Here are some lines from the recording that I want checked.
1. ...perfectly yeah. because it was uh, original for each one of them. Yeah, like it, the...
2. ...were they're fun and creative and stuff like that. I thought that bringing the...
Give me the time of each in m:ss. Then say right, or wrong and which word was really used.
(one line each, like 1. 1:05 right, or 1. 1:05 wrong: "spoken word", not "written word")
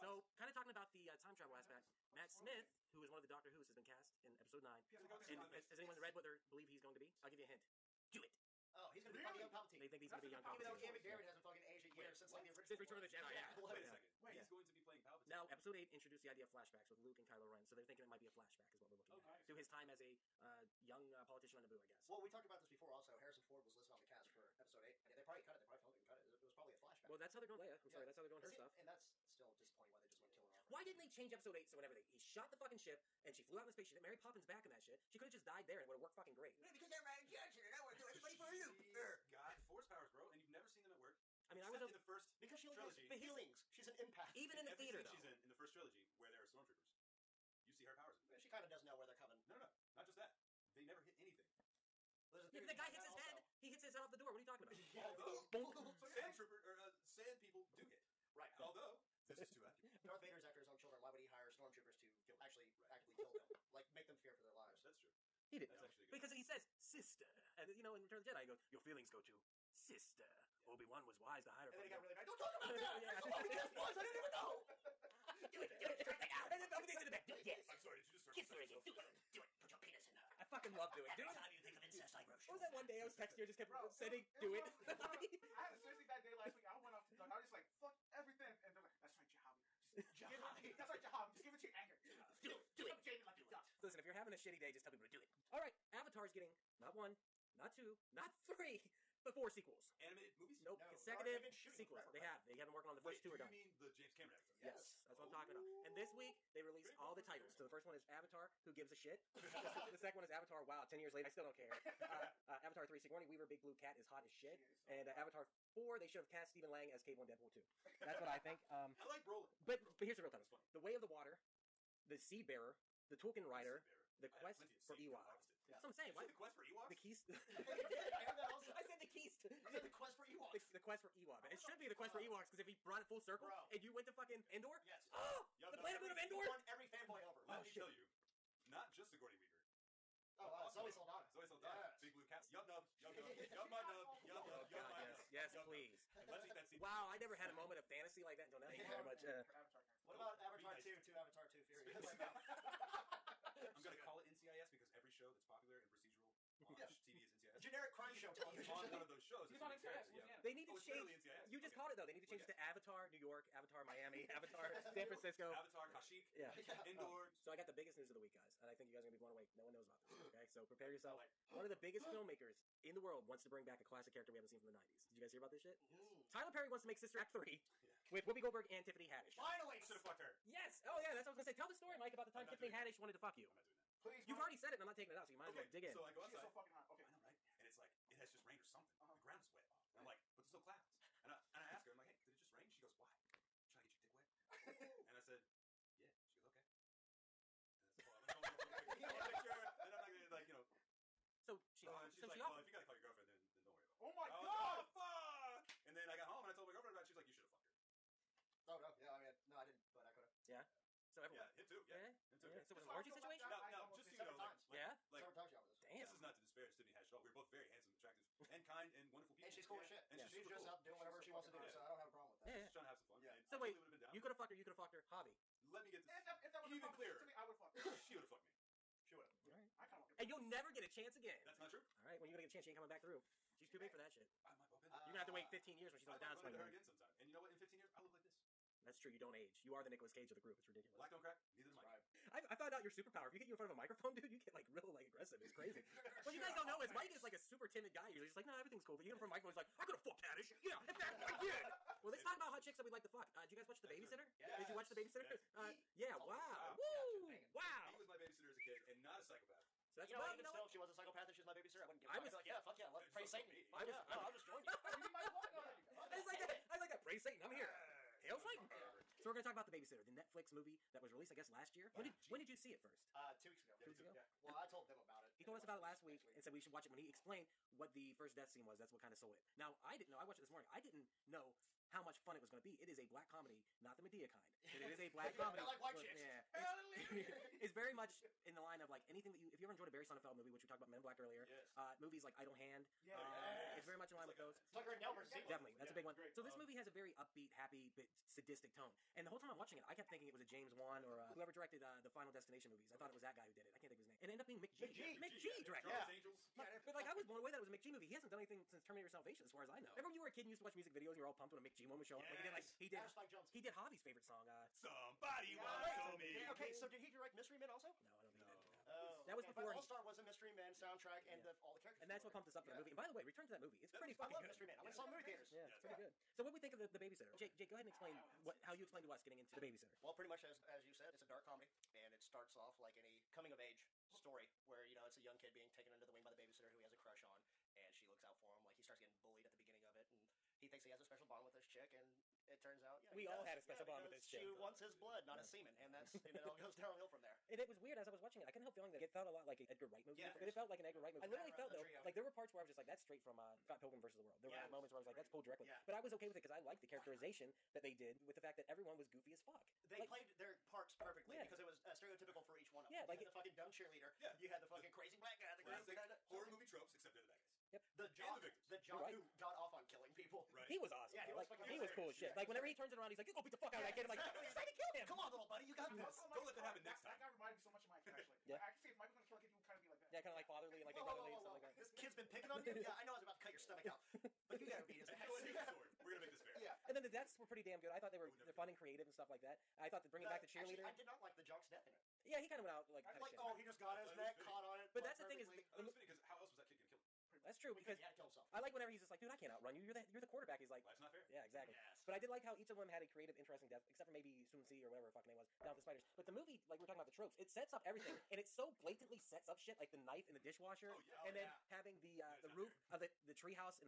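1. 6:00 wrong: "stereotypical", not "original"
2. 6:28 right.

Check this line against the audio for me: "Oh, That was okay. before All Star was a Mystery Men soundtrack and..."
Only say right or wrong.
right.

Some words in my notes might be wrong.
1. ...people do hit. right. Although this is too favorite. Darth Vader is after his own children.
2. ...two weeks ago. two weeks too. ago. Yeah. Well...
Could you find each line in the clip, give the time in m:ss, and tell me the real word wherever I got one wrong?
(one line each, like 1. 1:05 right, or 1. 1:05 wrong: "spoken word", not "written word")
1. 0:57 wrong: "accurate", not "favorite"
2. 4:33 right.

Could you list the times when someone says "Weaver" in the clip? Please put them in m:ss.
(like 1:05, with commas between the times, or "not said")
1:53, 2:19.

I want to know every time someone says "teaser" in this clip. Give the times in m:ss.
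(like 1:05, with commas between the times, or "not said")
not said.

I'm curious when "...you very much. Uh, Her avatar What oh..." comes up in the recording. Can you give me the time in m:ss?
2:28.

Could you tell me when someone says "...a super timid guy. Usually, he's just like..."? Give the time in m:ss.
4:07.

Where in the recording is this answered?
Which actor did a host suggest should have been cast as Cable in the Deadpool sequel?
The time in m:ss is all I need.
1:56.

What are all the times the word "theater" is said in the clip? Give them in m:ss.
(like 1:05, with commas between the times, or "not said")
0:44, 5:25.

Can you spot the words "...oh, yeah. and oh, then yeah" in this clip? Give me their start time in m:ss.
6:50.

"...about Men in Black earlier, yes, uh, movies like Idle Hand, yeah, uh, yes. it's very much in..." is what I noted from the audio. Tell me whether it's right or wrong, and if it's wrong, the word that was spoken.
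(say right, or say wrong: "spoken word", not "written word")
right.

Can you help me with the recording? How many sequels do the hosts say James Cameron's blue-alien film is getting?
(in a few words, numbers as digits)
4.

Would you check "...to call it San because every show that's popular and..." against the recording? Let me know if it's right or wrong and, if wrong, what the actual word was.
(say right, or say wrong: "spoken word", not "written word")
wrong: "NCIS", not "San".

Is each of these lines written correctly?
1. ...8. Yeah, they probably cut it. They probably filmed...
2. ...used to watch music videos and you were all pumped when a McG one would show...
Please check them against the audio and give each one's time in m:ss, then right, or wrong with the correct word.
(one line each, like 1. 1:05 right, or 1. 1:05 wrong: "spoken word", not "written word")
1. 0:24 right
2. 5:10 right.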